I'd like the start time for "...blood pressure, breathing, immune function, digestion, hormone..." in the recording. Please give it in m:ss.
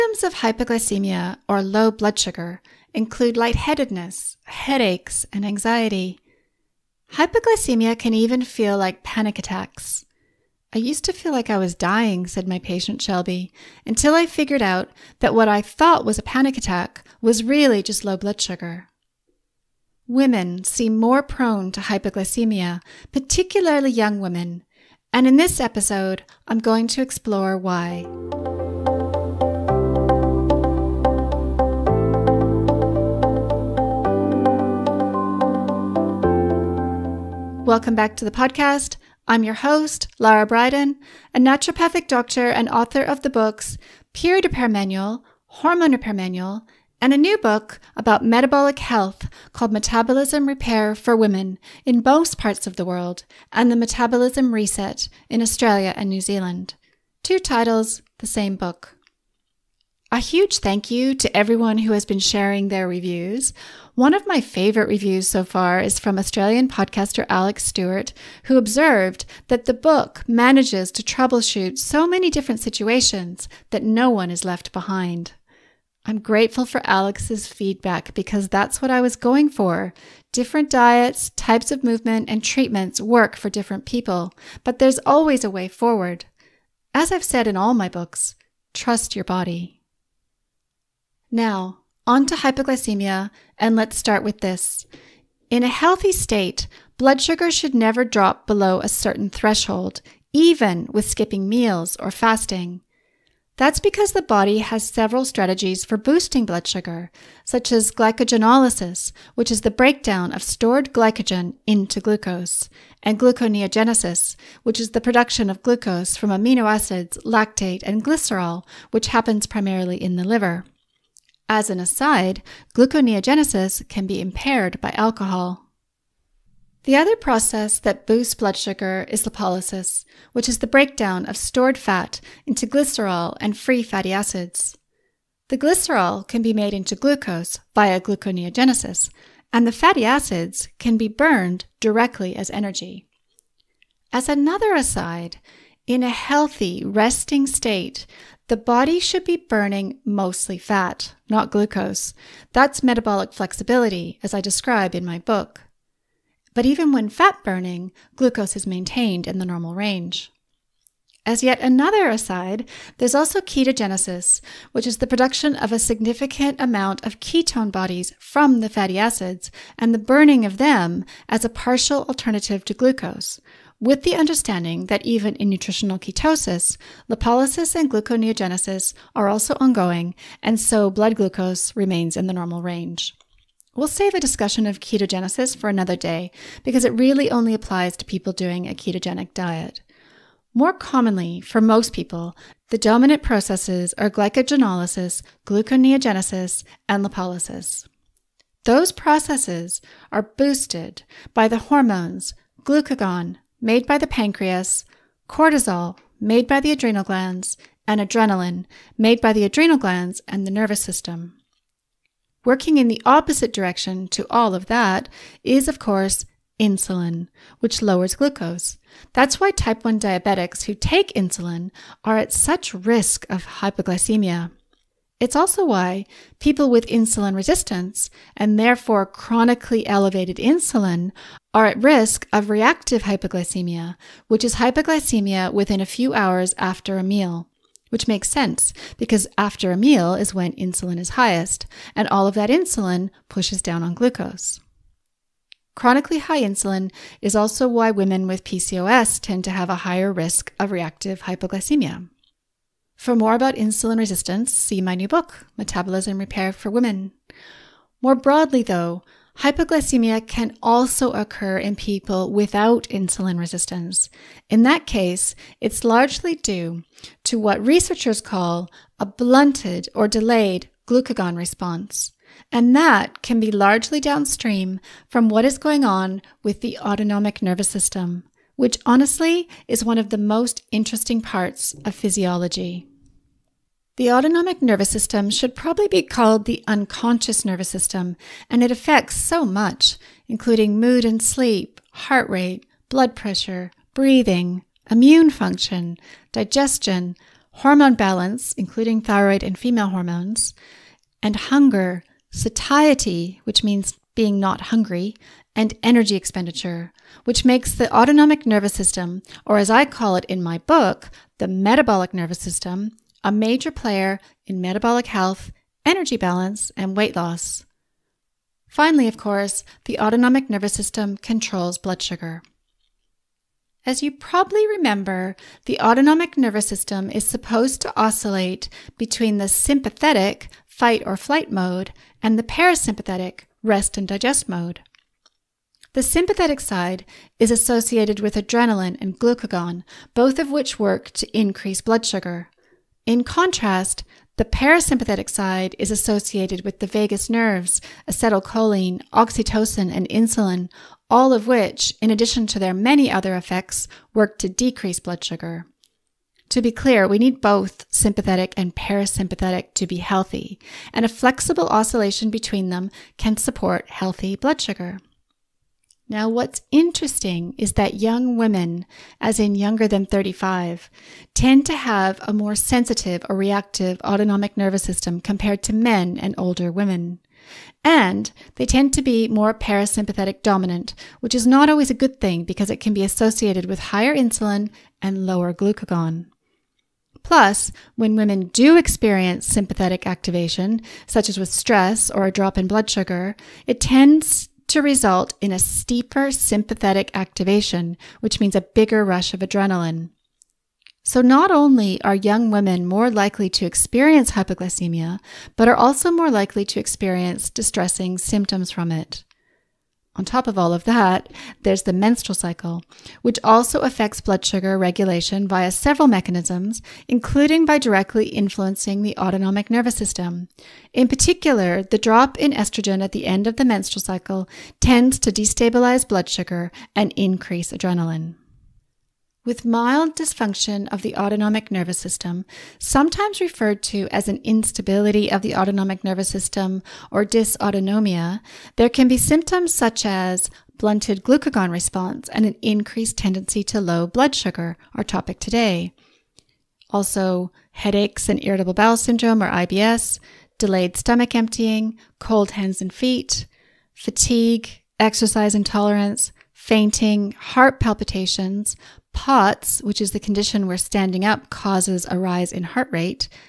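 4:52.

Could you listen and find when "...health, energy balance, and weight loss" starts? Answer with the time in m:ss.
5:15.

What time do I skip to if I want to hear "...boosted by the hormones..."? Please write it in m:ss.
3:20.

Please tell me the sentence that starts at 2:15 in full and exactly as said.
The glycerol can be made into glucose via gluconeogenesis, and the fatty acids can be burned directly as energy.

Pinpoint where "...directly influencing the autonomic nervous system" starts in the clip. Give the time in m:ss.
6:57.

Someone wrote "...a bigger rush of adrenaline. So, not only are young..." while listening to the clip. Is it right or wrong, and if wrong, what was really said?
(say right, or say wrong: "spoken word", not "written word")
right.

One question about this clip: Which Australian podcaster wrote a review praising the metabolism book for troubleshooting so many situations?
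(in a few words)
Alex Stewart.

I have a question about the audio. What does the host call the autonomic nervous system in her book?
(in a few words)
Metabolic nervous system.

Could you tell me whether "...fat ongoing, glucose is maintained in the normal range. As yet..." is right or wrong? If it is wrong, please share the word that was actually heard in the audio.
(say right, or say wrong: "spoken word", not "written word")
wrong: "burning", not "ongoing".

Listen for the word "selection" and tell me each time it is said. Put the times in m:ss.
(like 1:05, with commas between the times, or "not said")
not said.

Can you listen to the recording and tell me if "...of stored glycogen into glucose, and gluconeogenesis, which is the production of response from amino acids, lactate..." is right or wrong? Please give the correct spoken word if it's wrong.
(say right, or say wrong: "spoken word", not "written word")
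wrong: "glucose", not "response".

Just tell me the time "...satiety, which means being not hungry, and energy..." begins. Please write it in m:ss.
5:02.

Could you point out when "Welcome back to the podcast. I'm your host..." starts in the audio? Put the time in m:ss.
0:37.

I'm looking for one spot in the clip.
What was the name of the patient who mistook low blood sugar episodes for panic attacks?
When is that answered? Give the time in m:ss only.
0:13.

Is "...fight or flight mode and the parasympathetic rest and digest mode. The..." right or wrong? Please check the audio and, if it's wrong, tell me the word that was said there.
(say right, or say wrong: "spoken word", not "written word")
right.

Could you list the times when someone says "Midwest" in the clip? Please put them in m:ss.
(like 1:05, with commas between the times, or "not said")
not said.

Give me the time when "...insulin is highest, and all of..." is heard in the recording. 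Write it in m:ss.
4:00.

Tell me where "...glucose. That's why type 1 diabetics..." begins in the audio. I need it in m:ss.
3:38.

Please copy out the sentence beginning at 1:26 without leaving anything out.
As I've said in all my books, trust your body.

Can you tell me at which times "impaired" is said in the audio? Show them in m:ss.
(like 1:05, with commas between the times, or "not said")
2:04.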